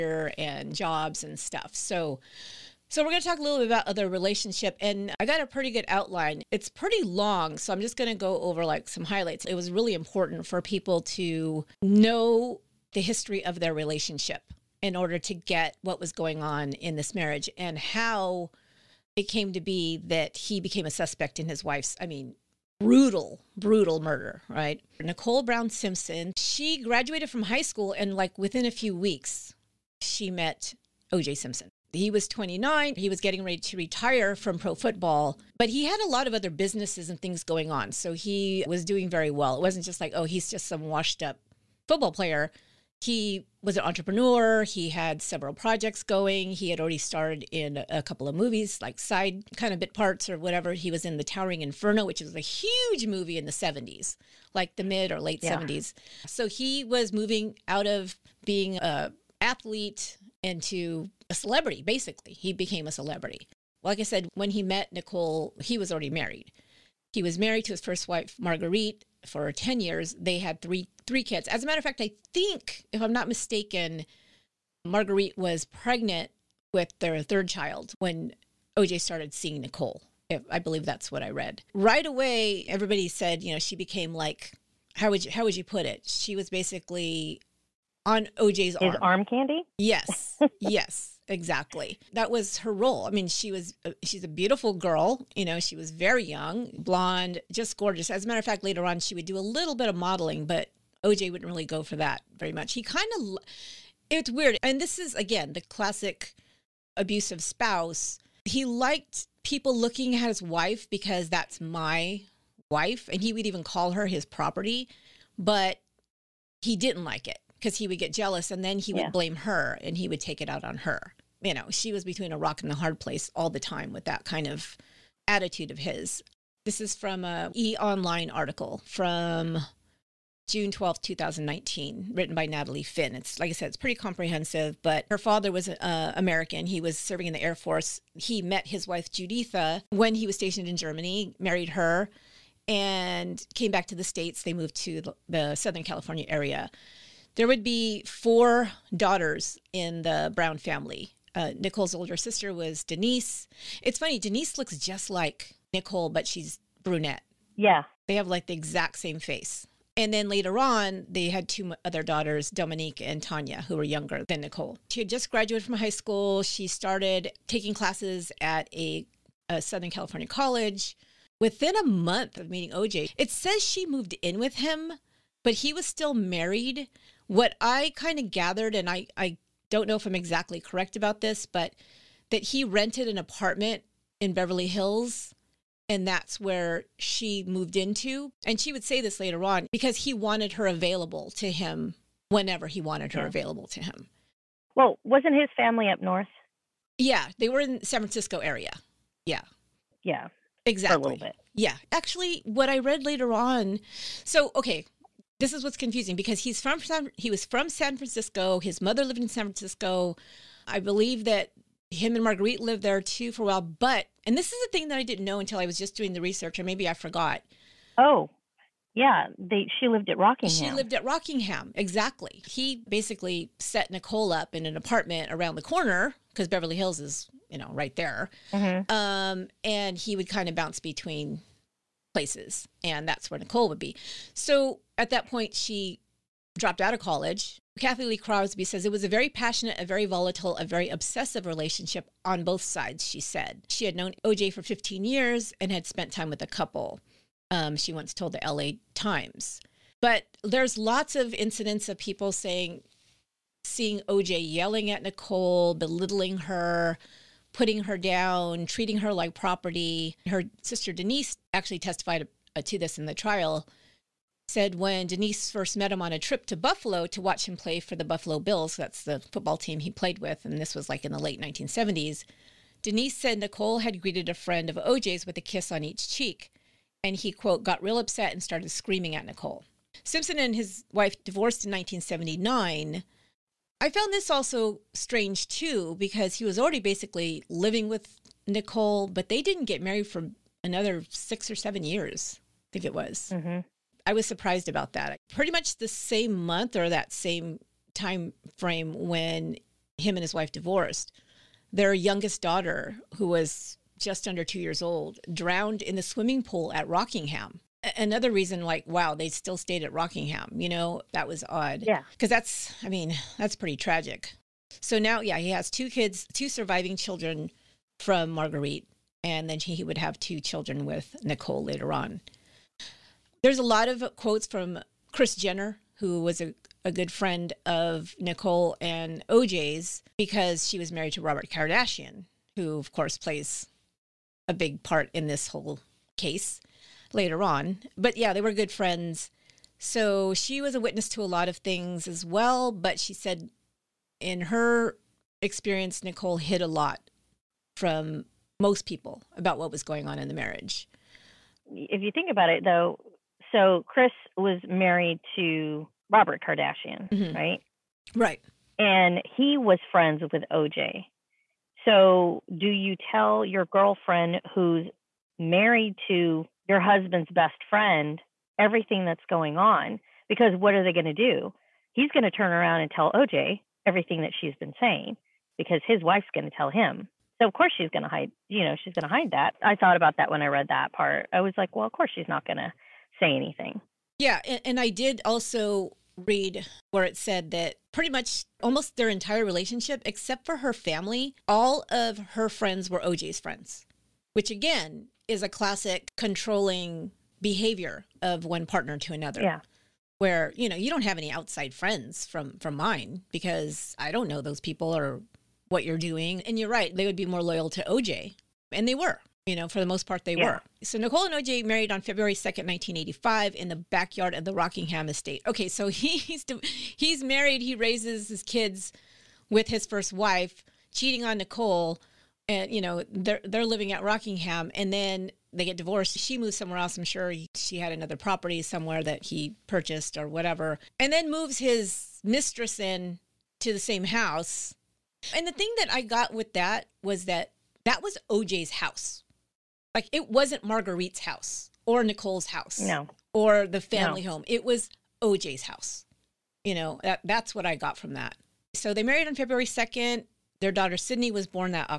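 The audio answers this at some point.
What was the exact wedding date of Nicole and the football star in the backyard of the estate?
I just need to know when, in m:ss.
6:52.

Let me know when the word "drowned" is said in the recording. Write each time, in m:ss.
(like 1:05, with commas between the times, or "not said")
5:05.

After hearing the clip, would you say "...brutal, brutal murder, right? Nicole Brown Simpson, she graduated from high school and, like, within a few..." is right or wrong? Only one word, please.
right.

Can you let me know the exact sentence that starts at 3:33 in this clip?
But and this is the thing that I didn't know until I was just doing the research, or maybe I forgot.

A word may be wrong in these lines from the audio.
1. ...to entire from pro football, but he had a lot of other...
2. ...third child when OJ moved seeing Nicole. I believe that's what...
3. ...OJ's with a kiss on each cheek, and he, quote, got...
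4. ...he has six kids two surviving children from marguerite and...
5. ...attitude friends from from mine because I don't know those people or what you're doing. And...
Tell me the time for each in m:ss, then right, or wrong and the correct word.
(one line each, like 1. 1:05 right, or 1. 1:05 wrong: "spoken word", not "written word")
1. 0:33 wrong: "retire", not "entire"
2. 1:17 wrong: "started", not "moved"
3. 4:34 right
4. 5:15 wrong: "two", not "six"
5. 6:41 wrong: "outside", not "attitude".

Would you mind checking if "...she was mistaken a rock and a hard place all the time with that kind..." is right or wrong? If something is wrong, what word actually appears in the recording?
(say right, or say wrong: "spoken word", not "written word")
wrong: "between", not "mistaken".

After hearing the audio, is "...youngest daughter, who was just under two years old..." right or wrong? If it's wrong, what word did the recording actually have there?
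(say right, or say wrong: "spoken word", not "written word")
right.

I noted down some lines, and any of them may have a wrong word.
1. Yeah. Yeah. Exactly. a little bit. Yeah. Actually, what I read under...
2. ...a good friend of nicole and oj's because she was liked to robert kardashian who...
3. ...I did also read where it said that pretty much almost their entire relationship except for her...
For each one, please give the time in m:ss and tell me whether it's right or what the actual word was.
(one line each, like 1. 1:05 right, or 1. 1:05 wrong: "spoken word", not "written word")
1. 3:19 wrong: "later", not "under"
2. 5:26 wrong: "married", not "liked"
3. 6:24 right.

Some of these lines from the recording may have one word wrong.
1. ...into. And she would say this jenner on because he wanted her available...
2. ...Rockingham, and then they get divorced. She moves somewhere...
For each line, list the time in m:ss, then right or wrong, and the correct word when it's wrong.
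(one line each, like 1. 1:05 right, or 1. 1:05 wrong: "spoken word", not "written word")
1. 3:07 wrong: "later", not "jenner"
2. 7:04 right.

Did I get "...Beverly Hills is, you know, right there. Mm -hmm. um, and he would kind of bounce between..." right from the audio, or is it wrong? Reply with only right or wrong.
right.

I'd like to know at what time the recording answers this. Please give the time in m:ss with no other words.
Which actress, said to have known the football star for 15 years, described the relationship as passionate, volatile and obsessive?
3:57.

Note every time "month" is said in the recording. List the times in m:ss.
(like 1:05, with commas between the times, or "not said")
2:51, 4:56.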